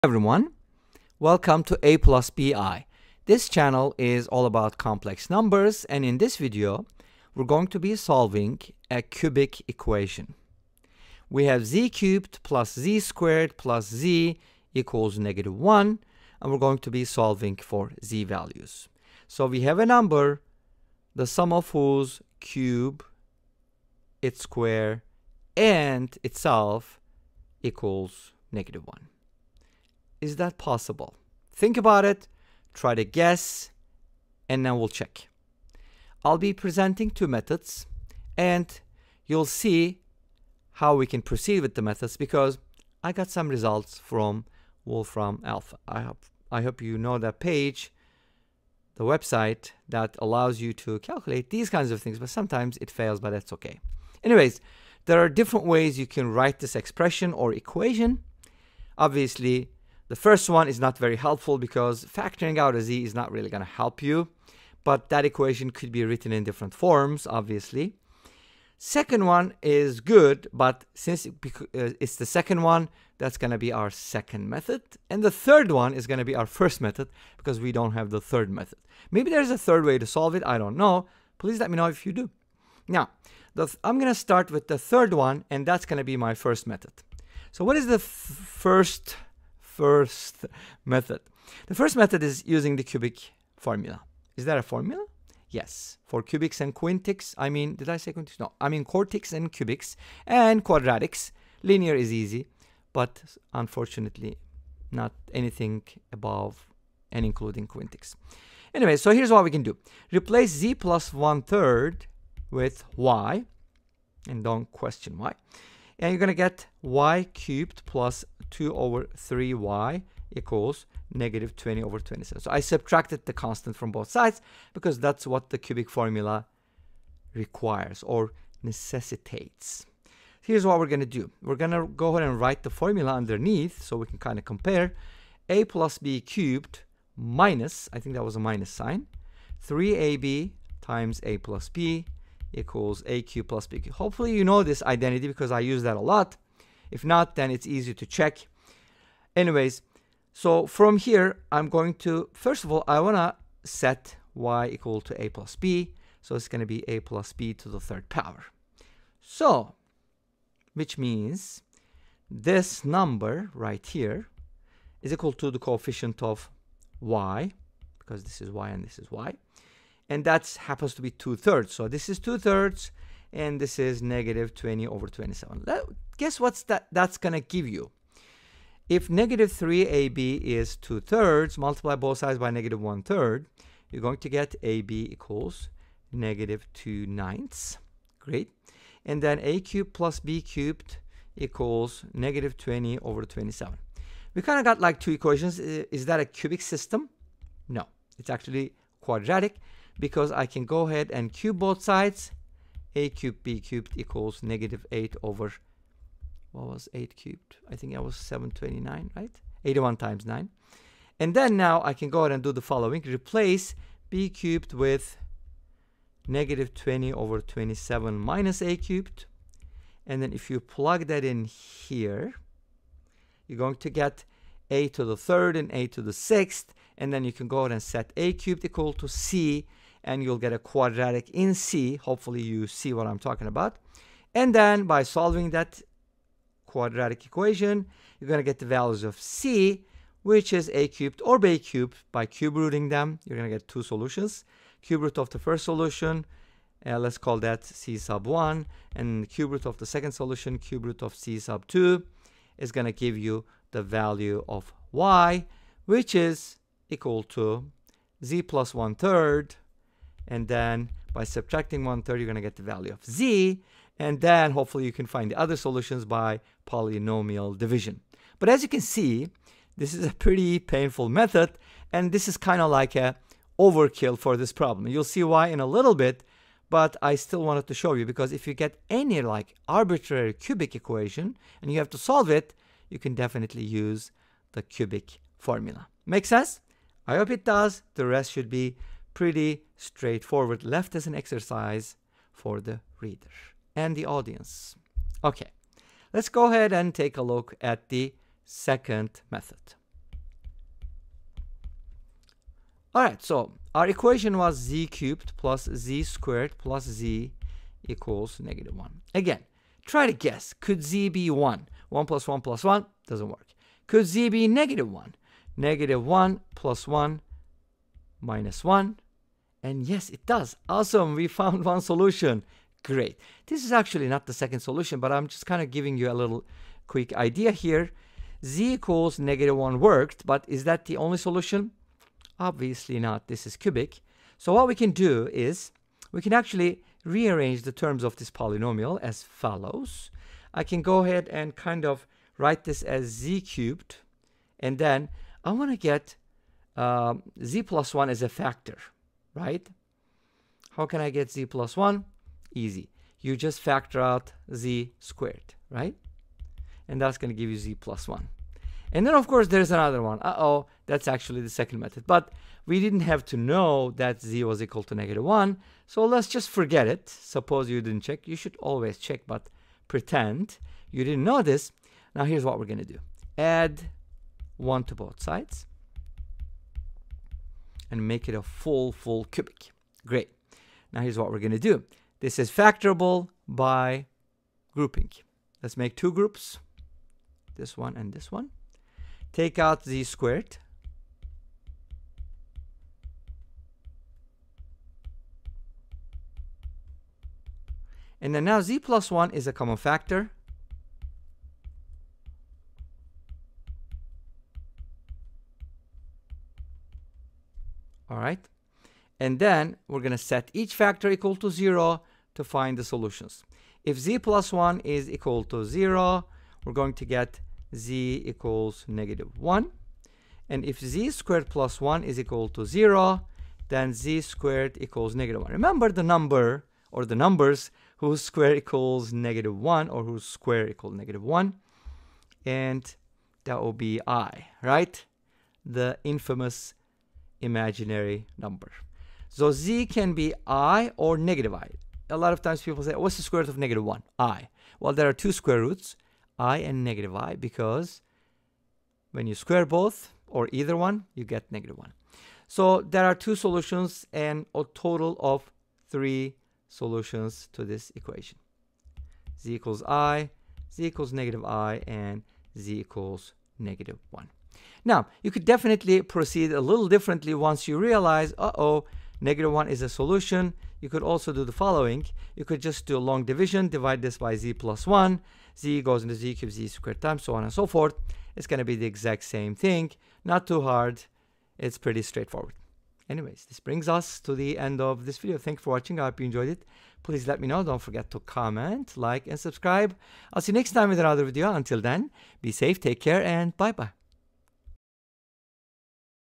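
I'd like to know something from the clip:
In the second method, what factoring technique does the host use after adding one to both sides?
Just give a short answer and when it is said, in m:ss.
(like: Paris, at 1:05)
grouping, at 6:22.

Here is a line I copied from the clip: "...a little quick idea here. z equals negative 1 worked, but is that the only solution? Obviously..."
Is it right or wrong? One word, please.
right.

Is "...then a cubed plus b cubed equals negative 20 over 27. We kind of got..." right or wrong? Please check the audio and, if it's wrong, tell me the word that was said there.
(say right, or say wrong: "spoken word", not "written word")
right.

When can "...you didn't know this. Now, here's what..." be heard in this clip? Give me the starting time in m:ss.
6:10.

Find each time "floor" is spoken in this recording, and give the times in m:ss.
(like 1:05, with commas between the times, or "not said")
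not said.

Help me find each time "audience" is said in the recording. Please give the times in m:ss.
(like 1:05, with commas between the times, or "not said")
4:54.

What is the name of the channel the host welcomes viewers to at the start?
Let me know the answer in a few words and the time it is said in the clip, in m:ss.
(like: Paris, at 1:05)
A plus BI, at 0:01.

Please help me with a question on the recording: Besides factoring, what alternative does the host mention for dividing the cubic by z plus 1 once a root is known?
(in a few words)
long division.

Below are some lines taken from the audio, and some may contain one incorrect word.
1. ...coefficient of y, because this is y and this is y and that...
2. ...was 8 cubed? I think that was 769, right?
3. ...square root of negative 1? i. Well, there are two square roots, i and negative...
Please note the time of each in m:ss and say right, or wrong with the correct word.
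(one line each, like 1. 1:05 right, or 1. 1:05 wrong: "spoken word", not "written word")
1. 2:45 right
2. 3:26 wrong: "729", not "769"
3. 7:23 right.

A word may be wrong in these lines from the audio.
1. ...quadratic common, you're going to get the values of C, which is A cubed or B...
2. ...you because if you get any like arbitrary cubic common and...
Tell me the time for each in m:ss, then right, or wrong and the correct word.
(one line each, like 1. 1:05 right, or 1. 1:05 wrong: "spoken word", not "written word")
1. 3:56 wrong: "equation", not "common"
2. 4:37 wrong: "equation", not "common".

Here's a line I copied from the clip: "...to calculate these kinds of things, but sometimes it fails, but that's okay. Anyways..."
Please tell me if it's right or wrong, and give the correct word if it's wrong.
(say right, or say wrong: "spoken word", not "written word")
right.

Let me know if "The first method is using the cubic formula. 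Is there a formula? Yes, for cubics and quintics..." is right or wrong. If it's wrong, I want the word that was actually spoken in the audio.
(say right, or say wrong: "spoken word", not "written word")
right.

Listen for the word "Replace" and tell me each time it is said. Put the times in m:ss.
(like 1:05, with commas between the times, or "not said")
1:50, 3:33.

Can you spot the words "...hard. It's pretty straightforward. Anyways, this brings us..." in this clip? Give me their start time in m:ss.
8:00.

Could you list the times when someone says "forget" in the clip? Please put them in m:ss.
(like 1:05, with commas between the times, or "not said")
6:06, 8:07.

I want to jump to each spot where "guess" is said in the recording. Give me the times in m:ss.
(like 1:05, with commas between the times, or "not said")
0:33, 2:56, 5:10.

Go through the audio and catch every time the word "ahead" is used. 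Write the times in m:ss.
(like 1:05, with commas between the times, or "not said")
2:12, 3:20, 3:32, 3:47, 4:56, 5:41.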